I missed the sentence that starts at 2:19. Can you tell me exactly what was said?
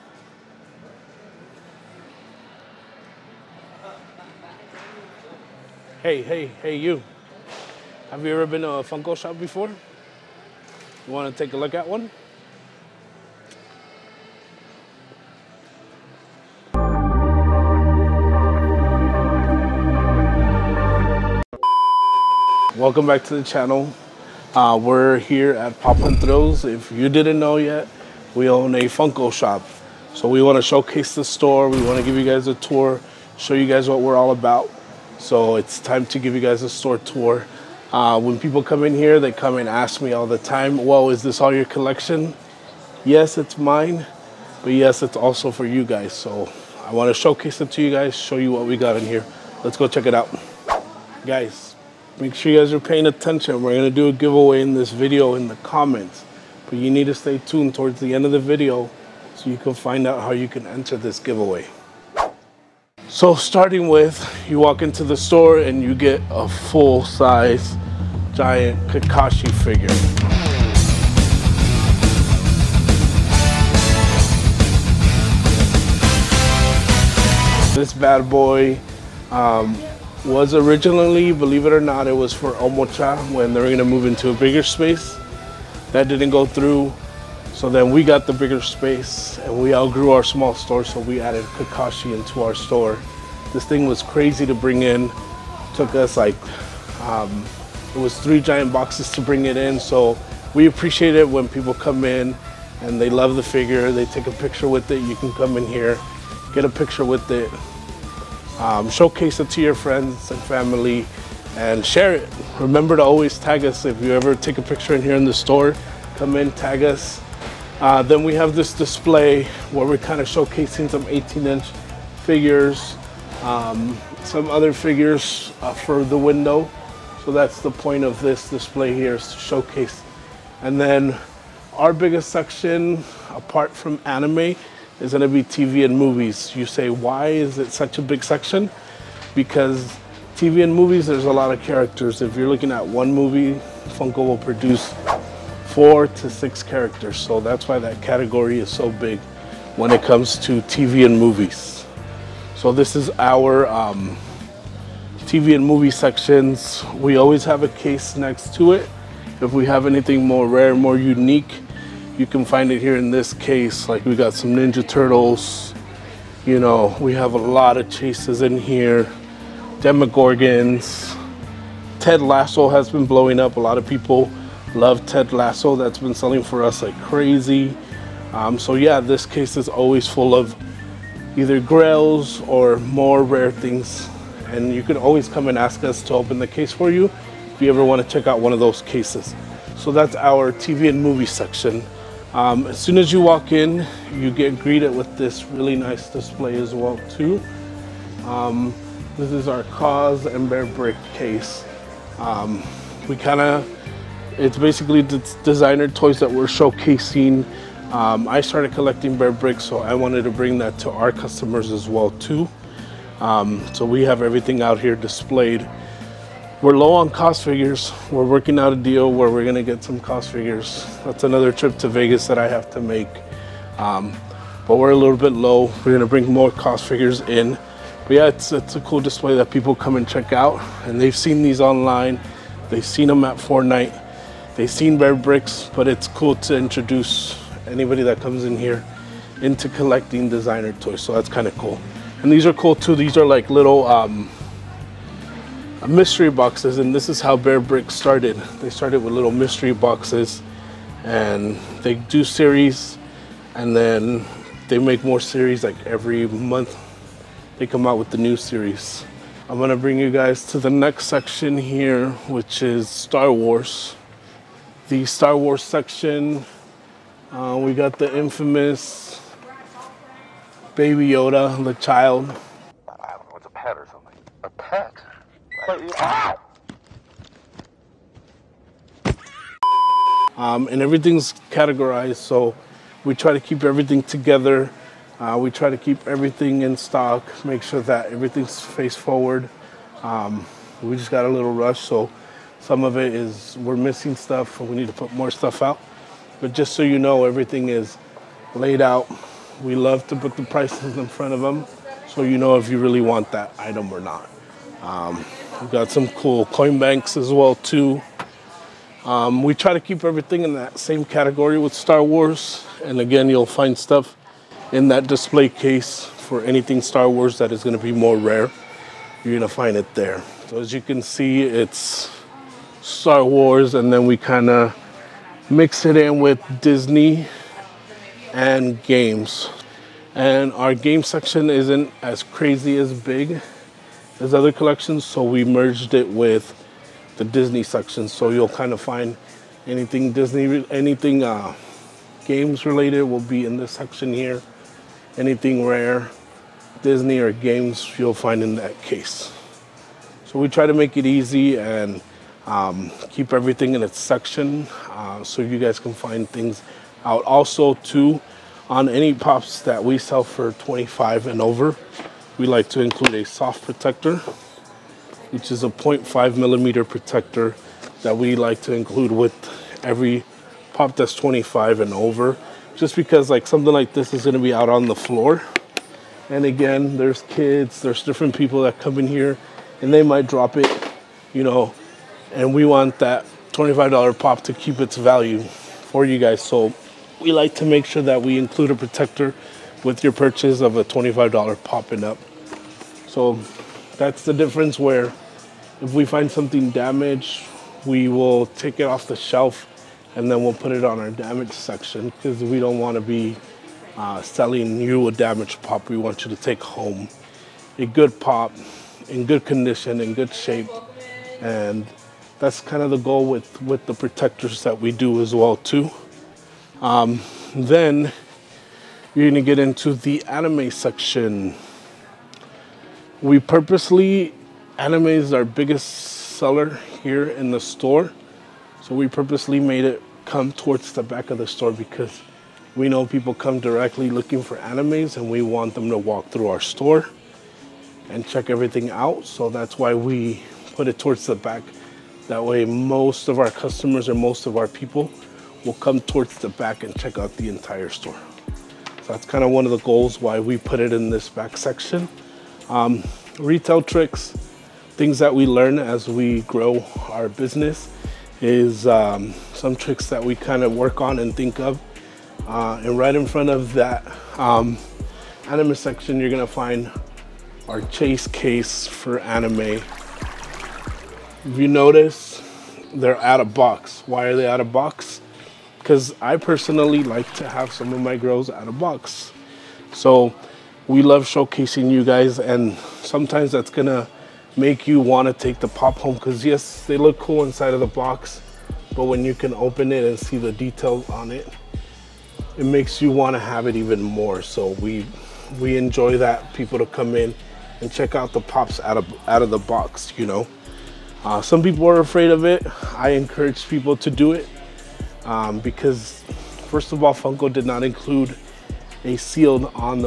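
Because TV and movies, there's a lot of characters.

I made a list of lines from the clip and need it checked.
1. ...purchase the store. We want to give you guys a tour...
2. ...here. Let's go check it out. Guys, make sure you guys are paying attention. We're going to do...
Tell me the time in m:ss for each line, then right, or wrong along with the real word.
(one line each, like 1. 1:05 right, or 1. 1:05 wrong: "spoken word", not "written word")
1. 0:30 wrong: "showcase", not "purchase"
2. 0:49 right.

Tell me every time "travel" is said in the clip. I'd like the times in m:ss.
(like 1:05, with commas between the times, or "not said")
not said.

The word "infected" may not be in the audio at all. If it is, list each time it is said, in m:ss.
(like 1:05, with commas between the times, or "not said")
not said.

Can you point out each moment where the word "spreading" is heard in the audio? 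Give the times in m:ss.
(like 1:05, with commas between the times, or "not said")
not said.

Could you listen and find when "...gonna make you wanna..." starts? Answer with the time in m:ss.
8:03.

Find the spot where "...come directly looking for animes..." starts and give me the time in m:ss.
7:13.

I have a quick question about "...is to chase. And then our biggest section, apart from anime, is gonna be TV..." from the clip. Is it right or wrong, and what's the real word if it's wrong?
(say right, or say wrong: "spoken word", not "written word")
wrong: "showcase", not "chase".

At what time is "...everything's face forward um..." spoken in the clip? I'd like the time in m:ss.
4:48.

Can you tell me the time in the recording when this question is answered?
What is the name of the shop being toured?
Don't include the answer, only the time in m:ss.
0:25.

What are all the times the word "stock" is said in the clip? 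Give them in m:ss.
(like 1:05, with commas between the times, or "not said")
4:46.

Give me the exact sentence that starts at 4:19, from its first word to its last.
I'm gonna bring you guys to the next section here, which is Star Wars the Star Wars section.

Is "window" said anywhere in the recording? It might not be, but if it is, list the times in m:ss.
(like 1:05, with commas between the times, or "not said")
2:06.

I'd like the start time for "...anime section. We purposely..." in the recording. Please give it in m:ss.
7:00.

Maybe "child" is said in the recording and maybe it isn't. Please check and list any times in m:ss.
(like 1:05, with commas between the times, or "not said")
4:31.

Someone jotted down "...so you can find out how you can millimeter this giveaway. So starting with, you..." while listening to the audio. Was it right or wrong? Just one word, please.
wrong.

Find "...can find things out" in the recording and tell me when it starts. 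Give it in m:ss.
5:55.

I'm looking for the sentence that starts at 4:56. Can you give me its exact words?
But just so you know, everything is laid out.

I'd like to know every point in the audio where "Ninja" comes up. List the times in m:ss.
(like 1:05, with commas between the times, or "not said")
2:44.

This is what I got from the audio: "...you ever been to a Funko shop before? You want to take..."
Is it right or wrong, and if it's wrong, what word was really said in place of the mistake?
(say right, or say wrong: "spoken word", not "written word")
right.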